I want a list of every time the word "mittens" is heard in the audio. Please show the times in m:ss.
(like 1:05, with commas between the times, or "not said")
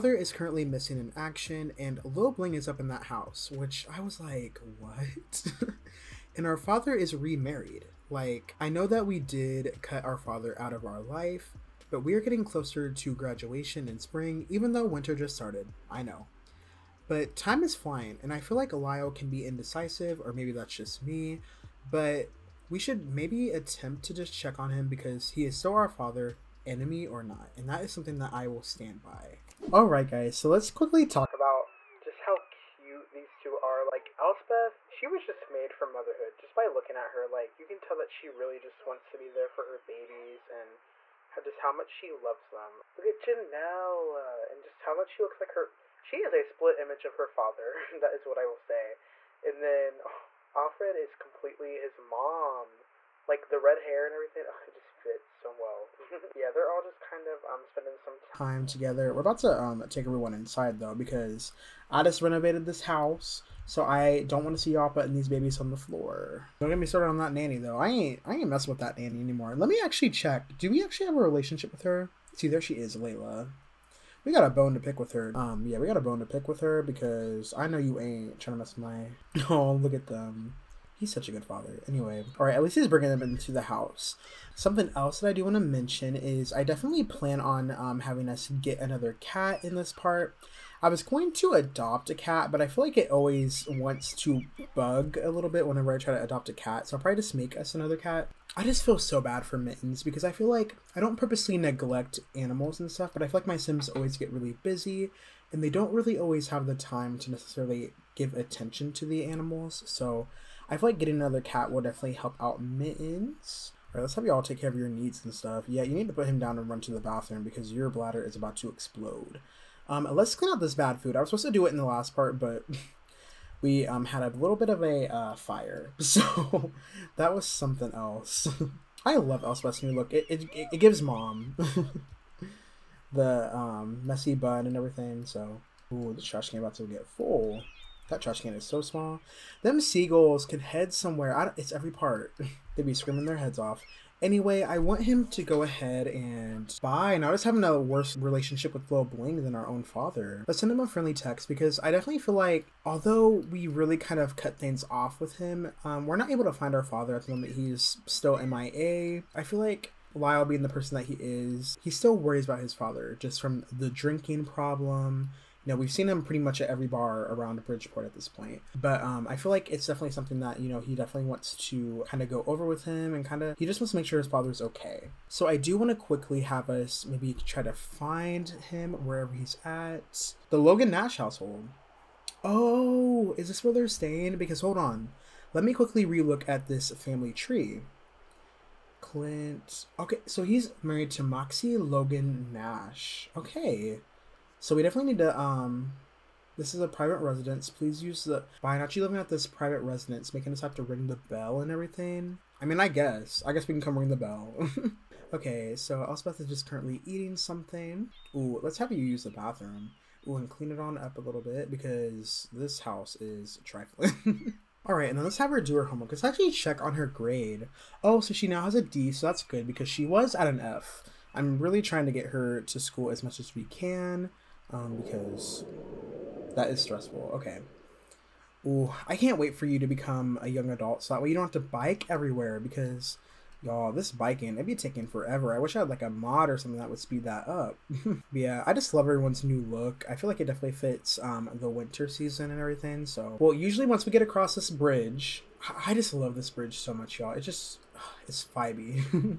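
1:39, 1:52.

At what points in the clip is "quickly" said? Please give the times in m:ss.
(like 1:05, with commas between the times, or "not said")
0:30, 2:55, 3:05.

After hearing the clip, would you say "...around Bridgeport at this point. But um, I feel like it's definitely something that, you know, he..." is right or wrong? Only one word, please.
right.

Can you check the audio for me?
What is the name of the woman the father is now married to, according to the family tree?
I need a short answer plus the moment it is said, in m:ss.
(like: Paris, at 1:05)
Moxie Logan Nash, at 3:11.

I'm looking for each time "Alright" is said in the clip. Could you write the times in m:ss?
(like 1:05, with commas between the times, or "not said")
0:29, 1:53.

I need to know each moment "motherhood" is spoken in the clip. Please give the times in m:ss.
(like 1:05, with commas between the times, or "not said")
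0:35.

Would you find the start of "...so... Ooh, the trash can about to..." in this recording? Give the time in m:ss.
2:15.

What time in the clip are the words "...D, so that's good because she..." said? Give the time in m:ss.
3:38.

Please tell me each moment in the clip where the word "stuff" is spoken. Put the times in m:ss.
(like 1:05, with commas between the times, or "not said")
1:42, 1:55.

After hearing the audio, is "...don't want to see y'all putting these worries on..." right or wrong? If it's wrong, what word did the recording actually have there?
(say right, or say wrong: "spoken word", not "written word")
wrong: "babies", not "worries".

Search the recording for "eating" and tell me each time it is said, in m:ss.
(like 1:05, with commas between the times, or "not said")
3:27.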